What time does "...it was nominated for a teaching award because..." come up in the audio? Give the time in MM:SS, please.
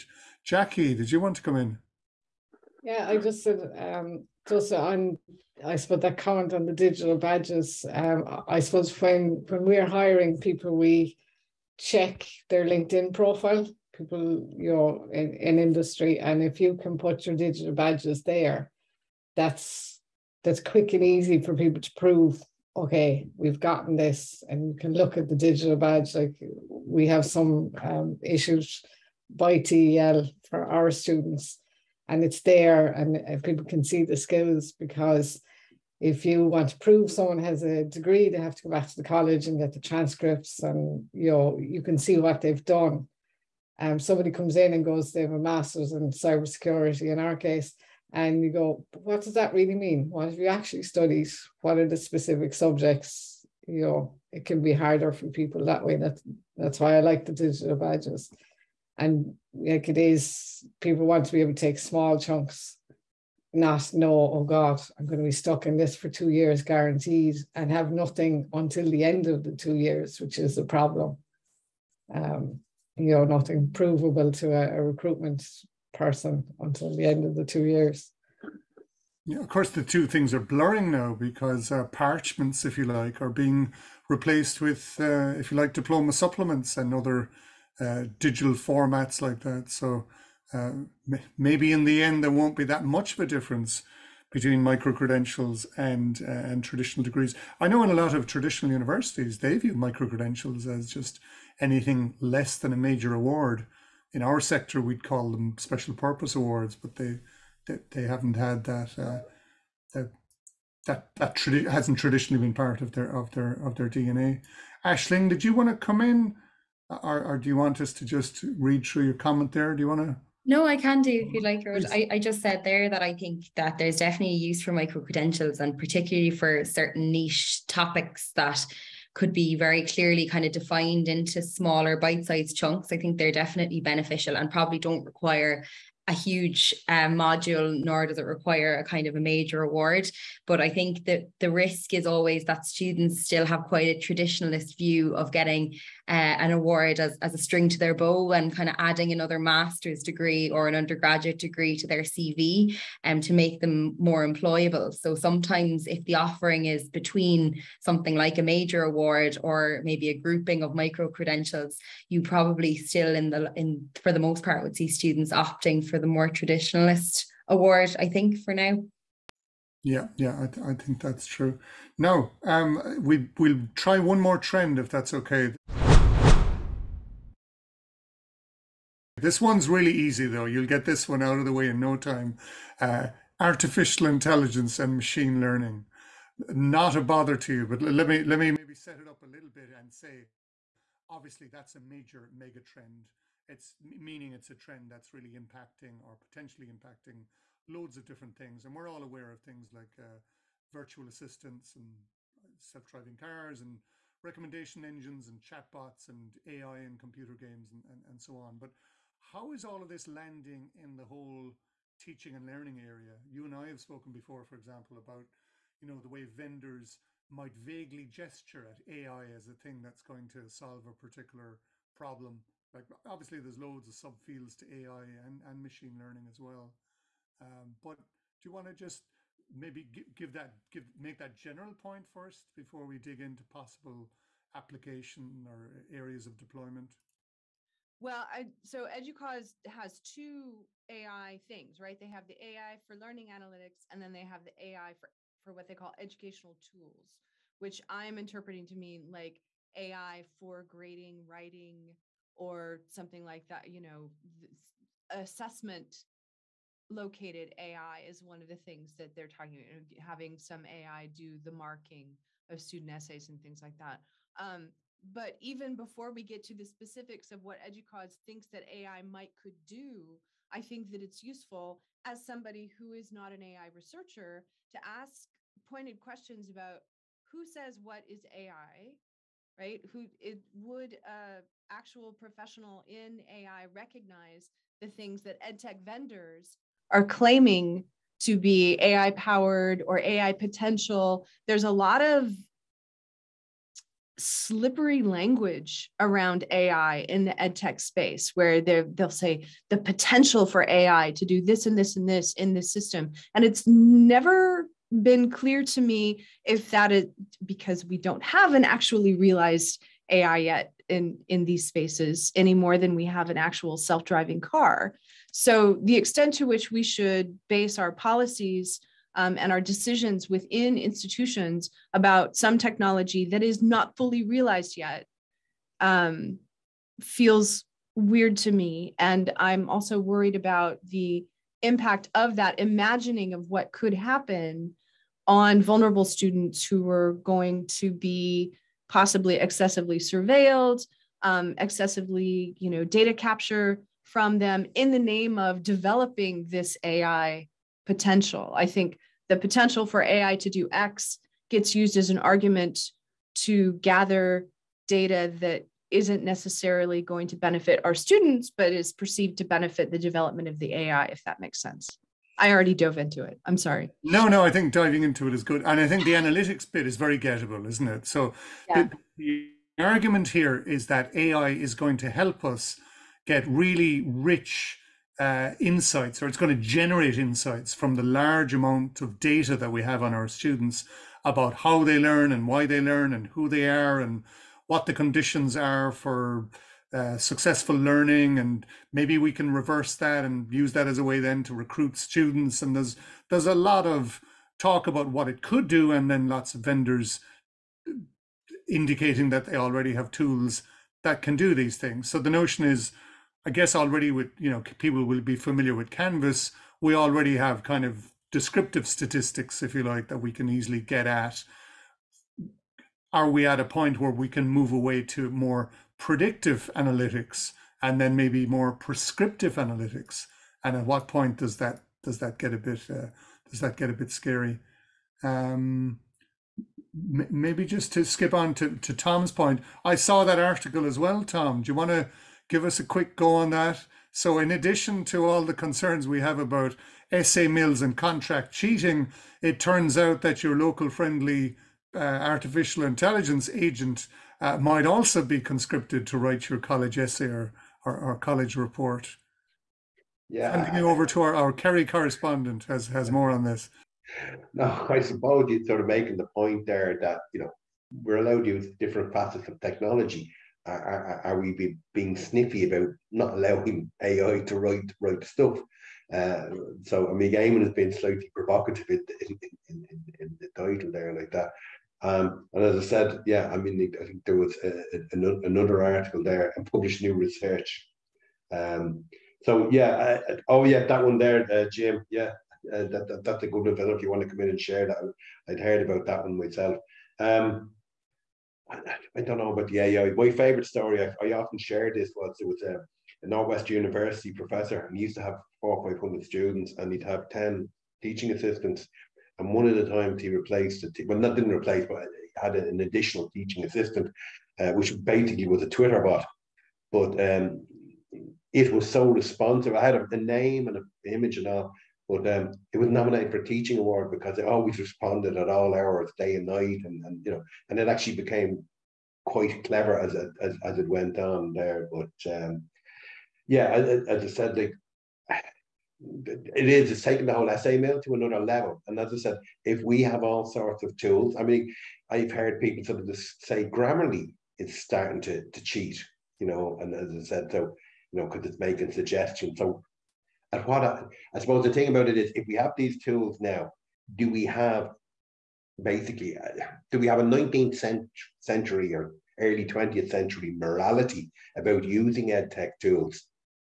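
08:32.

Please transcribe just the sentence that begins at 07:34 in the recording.
No, I suppose you're sort of making the point there that, you know, we're allowed to use different facets of technology.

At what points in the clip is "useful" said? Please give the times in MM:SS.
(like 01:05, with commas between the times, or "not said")
04:31.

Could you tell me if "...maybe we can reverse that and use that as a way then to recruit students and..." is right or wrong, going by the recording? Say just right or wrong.
right.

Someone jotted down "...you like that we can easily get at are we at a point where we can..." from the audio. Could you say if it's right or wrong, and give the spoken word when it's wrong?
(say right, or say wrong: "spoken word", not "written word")
right.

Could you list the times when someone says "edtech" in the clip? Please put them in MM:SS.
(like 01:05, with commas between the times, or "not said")
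04:45, 04:57.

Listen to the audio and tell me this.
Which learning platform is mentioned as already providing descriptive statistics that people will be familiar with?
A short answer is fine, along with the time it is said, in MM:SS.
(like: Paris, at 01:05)
Canvas, at 06:45.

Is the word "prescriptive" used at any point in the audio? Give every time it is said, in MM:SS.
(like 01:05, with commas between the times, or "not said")
06:58.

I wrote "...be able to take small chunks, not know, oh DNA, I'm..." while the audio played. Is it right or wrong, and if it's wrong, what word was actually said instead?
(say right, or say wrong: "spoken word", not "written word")
wrong: "God", not "DNA".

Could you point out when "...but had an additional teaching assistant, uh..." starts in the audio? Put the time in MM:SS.
08:21.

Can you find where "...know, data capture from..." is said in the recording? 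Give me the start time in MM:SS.
05:42.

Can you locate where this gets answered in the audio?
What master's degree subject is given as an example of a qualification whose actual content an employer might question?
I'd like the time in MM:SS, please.
00:46.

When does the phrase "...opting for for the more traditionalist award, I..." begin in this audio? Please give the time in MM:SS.
02:45.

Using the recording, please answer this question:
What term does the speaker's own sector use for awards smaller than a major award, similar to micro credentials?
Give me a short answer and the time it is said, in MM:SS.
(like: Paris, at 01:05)
Special purpose awards, at 01:45.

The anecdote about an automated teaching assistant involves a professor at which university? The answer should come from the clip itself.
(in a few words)
Northwest University.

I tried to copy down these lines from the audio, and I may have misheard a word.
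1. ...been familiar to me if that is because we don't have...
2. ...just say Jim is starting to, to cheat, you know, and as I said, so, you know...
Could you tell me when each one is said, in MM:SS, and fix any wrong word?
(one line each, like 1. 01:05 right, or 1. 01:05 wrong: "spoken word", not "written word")
1. 05:05 wrong: "clear", not "familiar"
2. 08:53 wrong: "Grammarly", not "Jim".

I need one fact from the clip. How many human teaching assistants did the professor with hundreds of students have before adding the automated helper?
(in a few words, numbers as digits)
10.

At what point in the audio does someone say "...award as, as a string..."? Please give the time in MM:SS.
02:26.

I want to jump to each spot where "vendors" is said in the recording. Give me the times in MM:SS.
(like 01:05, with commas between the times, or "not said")
03:36, 04:45, 06:36.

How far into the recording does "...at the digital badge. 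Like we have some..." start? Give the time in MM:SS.
00:25.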